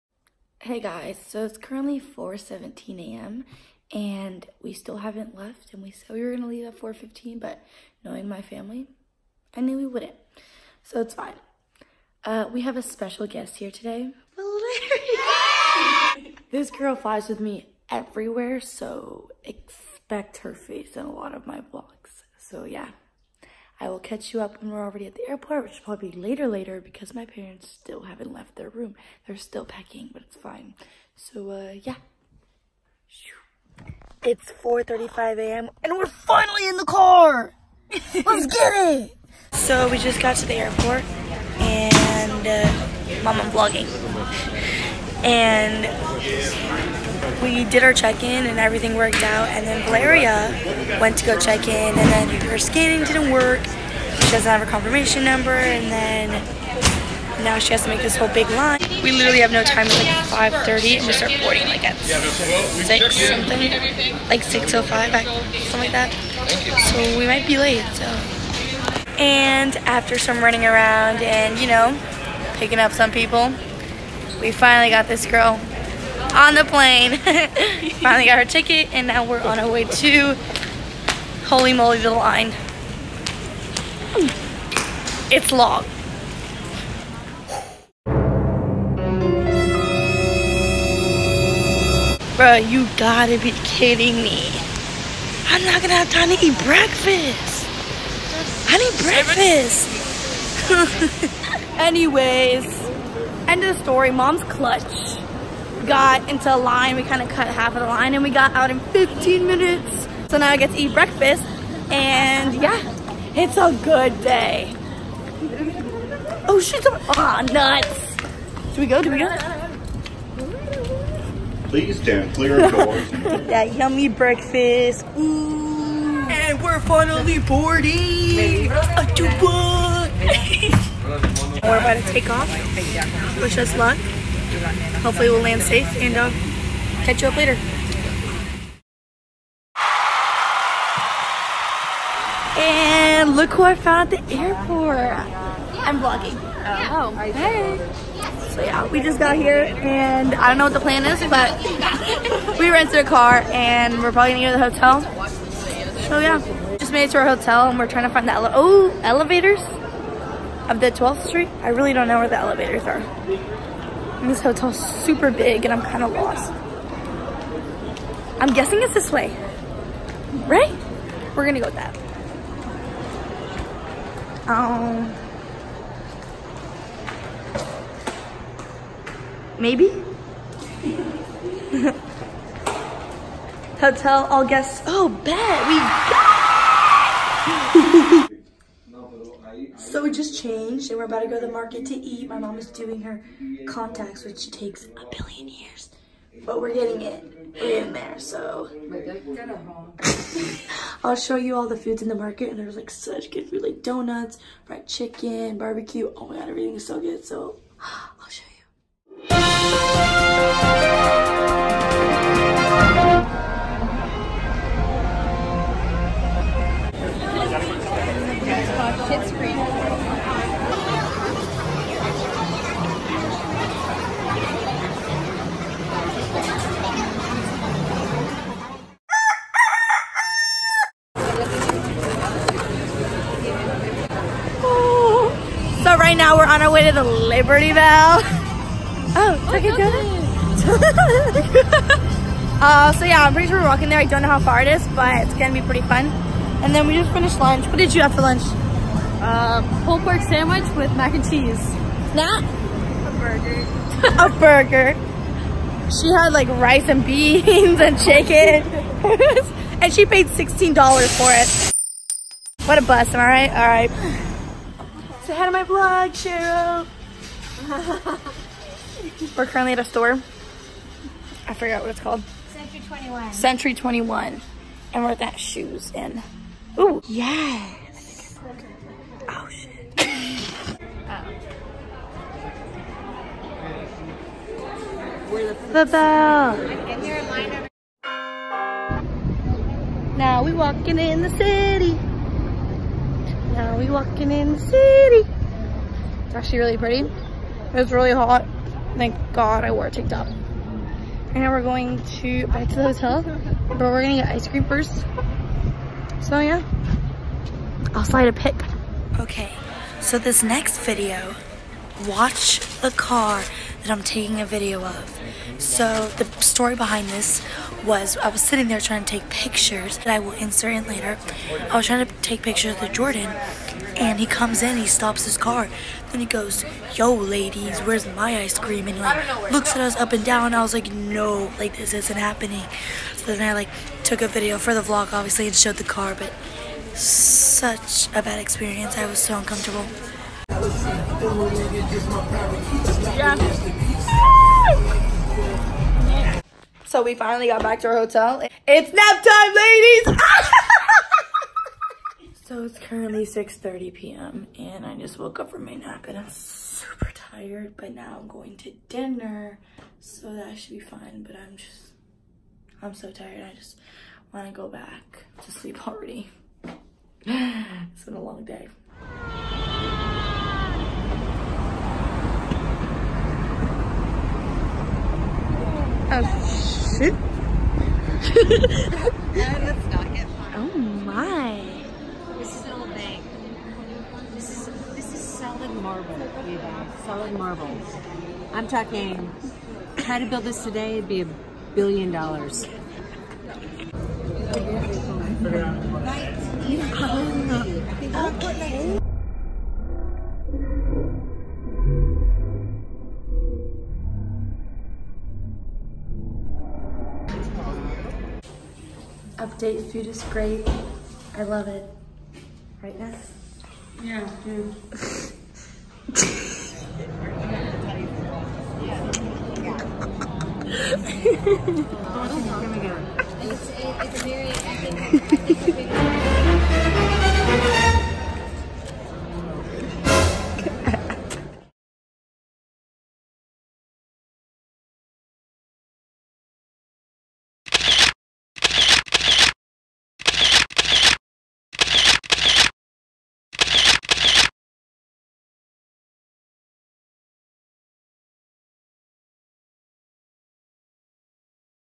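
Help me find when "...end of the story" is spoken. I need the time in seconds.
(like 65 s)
103 s.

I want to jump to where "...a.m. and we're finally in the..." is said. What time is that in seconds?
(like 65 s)
35 s.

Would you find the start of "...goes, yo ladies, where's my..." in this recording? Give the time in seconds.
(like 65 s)
326 s.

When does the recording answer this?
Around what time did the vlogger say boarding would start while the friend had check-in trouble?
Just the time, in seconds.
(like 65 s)
64 s.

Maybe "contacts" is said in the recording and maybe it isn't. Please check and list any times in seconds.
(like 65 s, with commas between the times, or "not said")
193 s.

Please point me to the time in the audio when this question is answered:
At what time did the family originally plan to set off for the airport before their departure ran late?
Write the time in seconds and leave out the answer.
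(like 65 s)
6 s.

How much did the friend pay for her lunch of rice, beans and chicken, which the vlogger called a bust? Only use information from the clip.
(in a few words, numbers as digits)
$16.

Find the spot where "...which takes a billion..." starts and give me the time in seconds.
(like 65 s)
194 s.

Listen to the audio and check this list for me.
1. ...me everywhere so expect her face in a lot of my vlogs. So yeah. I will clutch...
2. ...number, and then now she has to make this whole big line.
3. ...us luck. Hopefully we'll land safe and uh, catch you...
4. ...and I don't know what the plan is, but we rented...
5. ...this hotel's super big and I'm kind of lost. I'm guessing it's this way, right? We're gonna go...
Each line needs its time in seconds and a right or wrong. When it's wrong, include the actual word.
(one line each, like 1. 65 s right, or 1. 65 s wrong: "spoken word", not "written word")
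1. 17 s wrong: "catch", not "clutch"
2. 55 s right
3. 133 s right
4. 149 s right
5. 164 s right.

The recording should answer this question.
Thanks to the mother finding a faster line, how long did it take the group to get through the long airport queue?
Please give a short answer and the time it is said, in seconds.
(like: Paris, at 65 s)
15 minutes, at 108 s.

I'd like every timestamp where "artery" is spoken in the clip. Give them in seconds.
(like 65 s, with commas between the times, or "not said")
not said.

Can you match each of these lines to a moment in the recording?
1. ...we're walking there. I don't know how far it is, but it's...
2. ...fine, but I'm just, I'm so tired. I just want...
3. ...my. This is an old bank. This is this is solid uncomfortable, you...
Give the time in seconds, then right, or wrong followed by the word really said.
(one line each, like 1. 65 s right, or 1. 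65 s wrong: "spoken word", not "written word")
1. 243 s right
2. 360 s right
3. 381 s wrong: "marble", not "uncomfortable".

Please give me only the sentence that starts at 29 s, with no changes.
They're still packing, but it's fine.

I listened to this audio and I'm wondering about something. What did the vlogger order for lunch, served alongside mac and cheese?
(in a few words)
Pulled pork sandwich.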